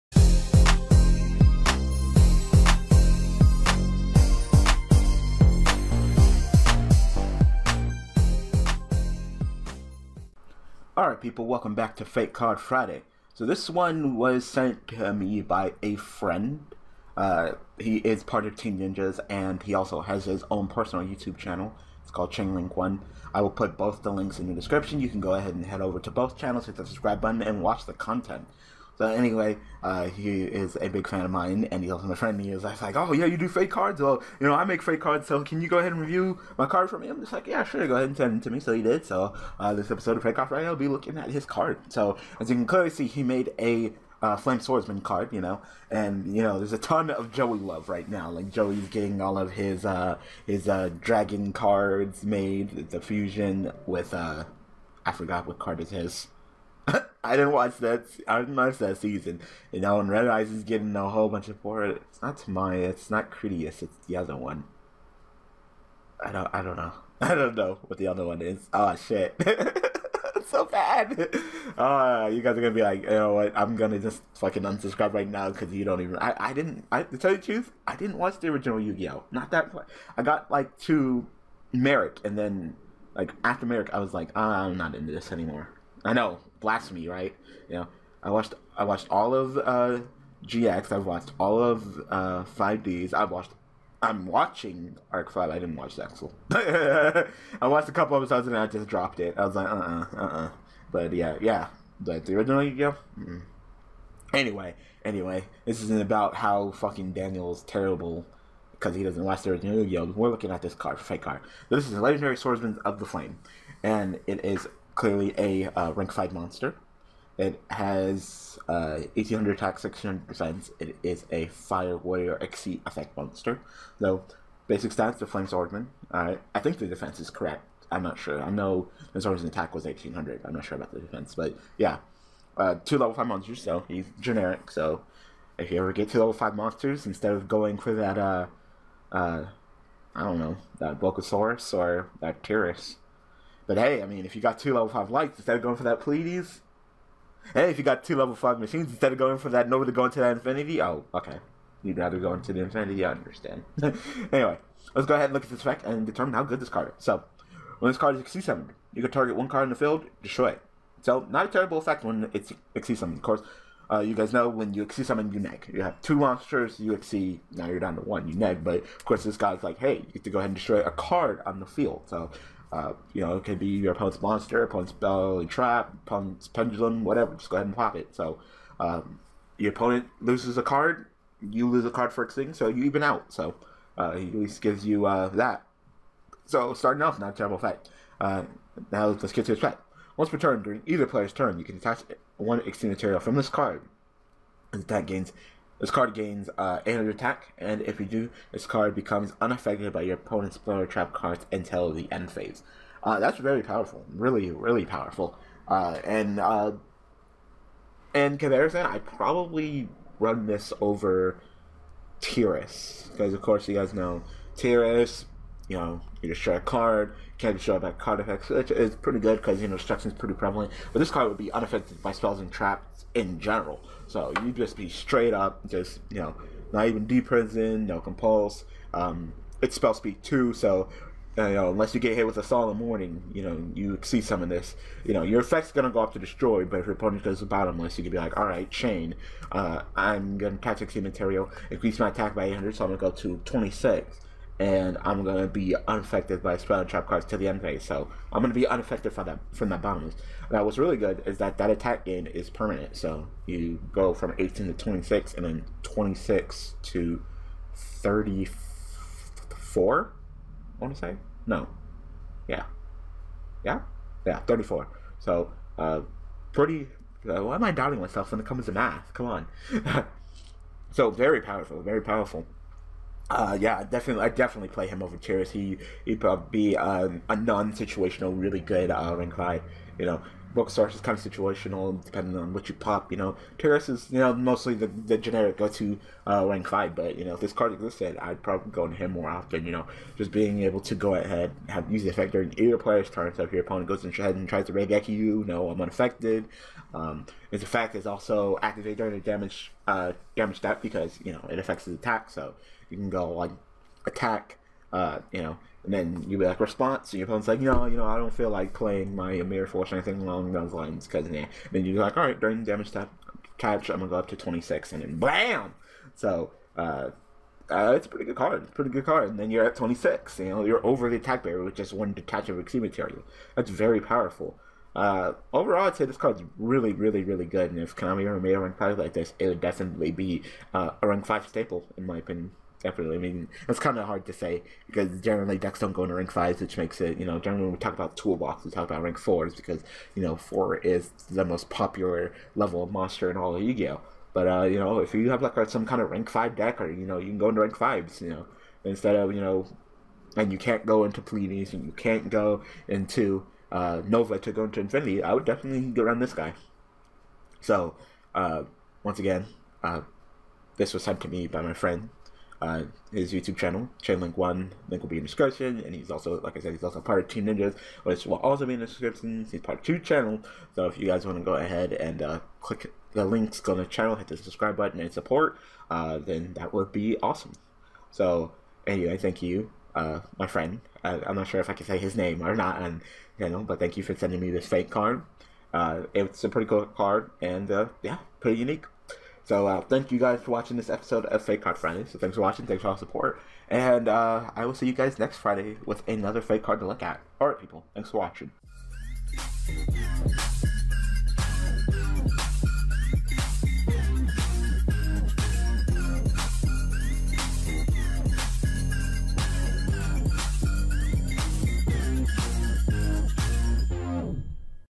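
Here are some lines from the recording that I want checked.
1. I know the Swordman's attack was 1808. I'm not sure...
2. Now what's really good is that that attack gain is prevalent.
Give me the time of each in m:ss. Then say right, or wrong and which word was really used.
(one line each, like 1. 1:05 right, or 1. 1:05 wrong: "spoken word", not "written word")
1. 2:08 wrong: "1800", not "1808"
2. 4:10 wrong: "permanent", not "prevalent".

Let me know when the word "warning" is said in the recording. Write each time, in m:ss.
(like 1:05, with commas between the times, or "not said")
3:52.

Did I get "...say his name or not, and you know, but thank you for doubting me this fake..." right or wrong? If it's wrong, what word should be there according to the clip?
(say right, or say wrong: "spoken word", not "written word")
wrong: "sending", not "doubting".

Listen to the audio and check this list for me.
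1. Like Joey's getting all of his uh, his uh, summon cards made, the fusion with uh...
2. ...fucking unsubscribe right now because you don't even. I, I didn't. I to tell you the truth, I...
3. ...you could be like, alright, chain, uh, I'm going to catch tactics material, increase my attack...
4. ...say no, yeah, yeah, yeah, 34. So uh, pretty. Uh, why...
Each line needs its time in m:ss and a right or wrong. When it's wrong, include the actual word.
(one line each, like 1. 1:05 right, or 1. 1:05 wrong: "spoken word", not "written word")
1. 0:48 wrong: "dragon", not "summon"
2. 1:14 right
3. 3:57 right
4. 4:20 right.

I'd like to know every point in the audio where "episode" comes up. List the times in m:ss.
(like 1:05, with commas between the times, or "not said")
0:39, 1:38, 6:30.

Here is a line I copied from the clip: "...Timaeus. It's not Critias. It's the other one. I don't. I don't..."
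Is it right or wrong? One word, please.
right.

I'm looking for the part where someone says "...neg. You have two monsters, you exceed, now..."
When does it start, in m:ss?
2:45.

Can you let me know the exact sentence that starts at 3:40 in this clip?
But this card would be unaffected by spells and traps in general.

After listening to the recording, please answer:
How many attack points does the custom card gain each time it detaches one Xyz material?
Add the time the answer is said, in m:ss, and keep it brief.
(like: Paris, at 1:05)
800, at 3:16.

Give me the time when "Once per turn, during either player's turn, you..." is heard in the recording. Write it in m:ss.
3:10.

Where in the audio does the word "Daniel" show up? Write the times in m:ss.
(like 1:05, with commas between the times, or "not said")
1:47.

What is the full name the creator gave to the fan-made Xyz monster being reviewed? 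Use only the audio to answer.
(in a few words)
Legendary Swordsman of the Flame.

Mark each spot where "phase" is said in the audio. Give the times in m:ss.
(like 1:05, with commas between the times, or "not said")
3:22, 4:07.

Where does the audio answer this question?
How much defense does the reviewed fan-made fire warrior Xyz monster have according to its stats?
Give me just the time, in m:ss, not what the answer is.
1:59.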